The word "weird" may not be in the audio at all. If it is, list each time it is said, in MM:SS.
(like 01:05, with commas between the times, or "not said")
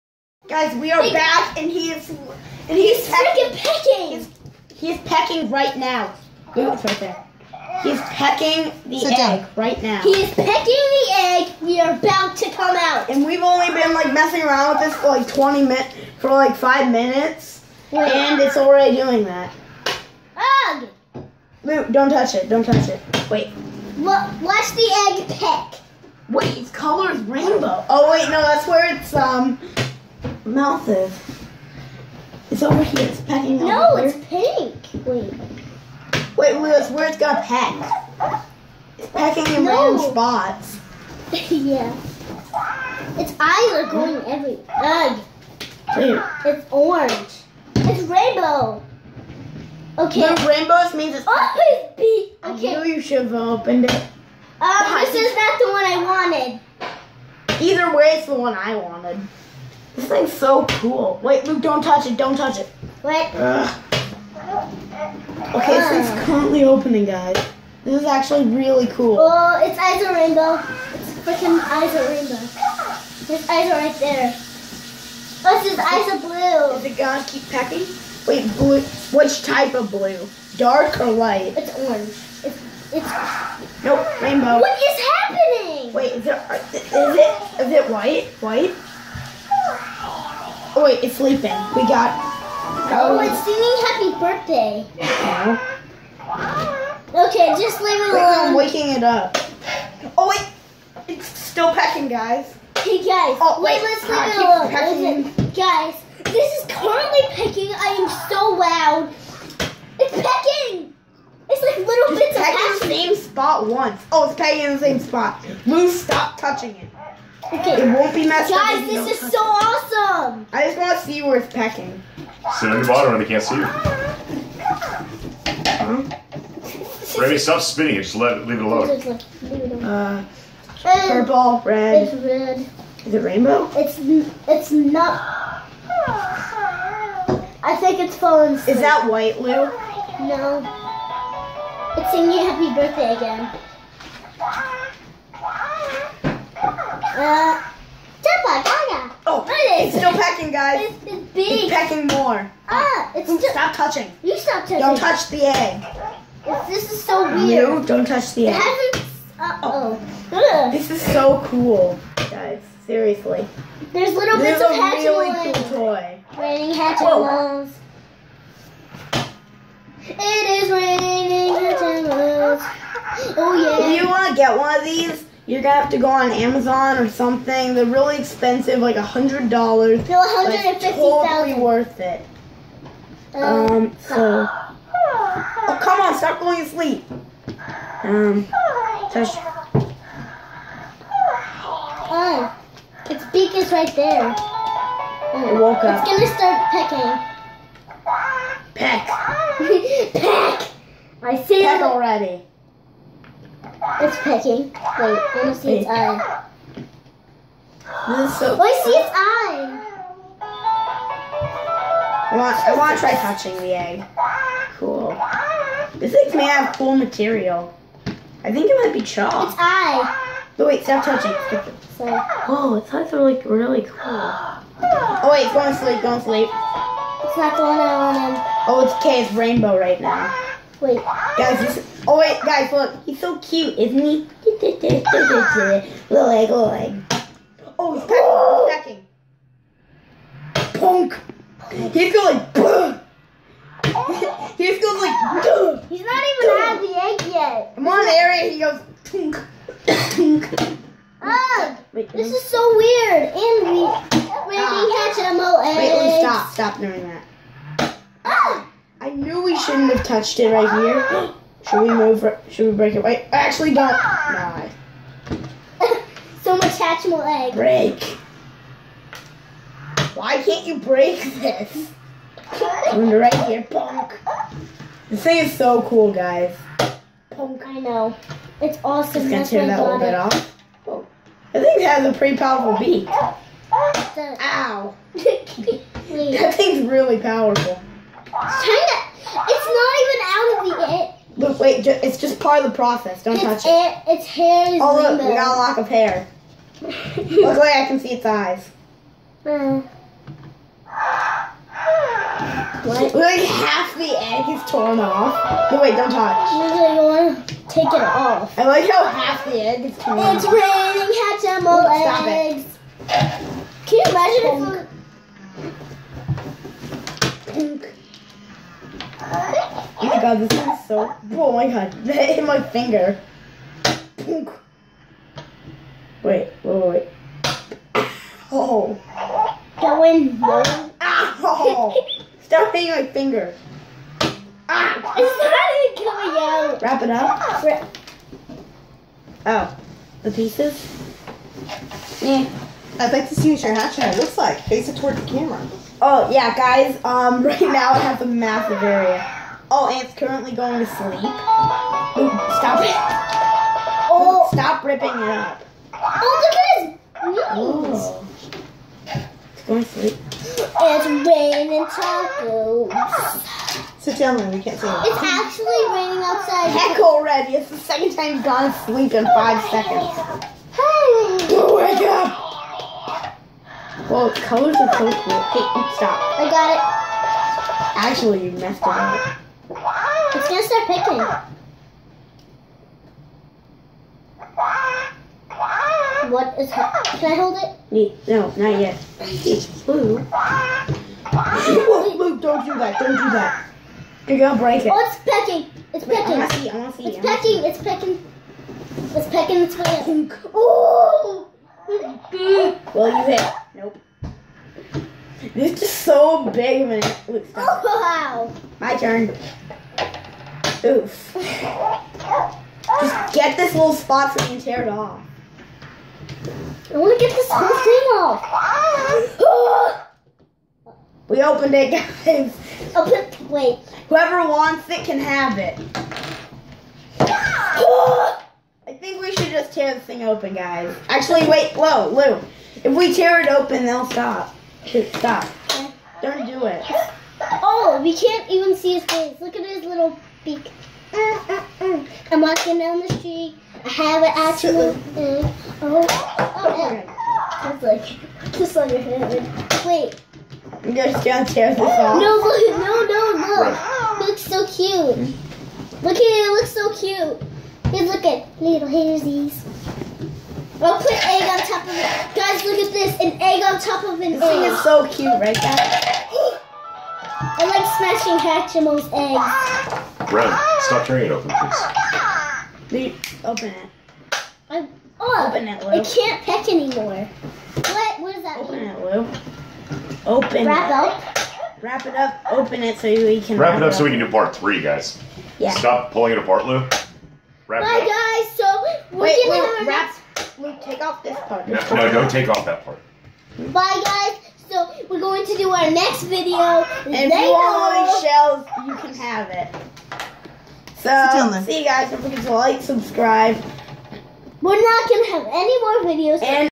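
02:37, 04:12.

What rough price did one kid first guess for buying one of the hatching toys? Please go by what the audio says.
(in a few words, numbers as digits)
100 dollars.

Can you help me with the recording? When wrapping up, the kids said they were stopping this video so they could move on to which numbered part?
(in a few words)
part 3.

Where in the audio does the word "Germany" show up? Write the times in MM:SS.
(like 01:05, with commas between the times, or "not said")
not said.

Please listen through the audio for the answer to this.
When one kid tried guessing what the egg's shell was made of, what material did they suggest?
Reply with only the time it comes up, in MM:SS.
03:39.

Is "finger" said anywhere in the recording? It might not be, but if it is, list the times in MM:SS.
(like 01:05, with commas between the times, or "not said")
05:22, 05:33.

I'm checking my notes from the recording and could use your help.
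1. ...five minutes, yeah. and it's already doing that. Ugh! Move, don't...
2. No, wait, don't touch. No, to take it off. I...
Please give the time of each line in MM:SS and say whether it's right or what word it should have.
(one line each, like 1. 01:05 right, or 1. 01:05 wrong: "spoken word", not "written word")
1. 00:16 right
2. 05:05 right.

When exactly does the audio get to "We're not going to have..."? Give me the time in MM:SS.
08:24.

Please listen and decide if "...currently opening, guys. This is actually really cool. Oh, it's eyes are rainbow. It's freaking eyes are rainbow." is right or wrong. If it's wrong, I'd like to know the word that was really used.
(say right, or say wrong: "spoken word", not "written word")
right.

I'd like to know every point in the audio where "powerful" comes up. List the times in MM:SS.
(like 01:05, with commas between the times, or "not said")
04:42, 04:47.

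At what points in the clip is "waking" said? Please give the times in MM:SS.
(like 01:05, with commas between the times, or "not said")
01:38.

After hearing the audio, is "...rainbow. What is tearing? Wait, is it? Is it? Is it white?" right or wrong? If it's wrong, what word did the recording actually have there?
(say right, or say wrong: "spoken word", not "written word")
wrong: "happening", not "tearing".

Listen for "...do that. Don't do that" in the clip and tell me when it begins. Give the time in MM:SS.
06:32.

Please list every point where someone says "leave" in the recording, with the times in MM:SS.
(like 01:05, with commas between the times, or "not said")
01:37, 01:44, 02:08, 07:52.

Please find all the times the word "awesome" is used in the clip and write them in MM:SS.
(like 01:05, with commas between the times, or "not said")
01:59, 04:38.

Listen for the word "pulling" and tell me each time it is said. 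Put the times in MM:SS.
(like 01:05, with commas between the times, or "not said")
08:06.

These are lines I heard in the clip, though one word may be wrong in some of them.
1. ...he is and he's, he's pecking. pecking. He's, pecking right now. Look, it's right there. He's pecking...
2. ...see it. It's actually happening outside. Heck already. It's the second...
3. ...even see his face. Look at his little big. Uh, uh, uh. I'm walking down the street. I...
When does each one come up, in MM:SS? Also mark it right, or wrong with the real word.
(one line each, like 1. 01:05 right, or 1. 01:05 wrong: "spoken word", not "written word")
1. 00:01 right
2. 06:04 wrong: "raining", not "happening"
3. 07:18 right.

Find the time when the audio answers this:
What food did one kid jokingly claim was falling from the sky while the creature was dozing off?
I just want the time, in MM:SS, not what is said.
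06:01.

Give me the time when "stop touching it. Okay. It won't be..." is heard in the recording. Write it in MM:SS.
01:55.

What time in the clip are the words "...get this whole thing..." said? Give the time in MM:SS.
06:57.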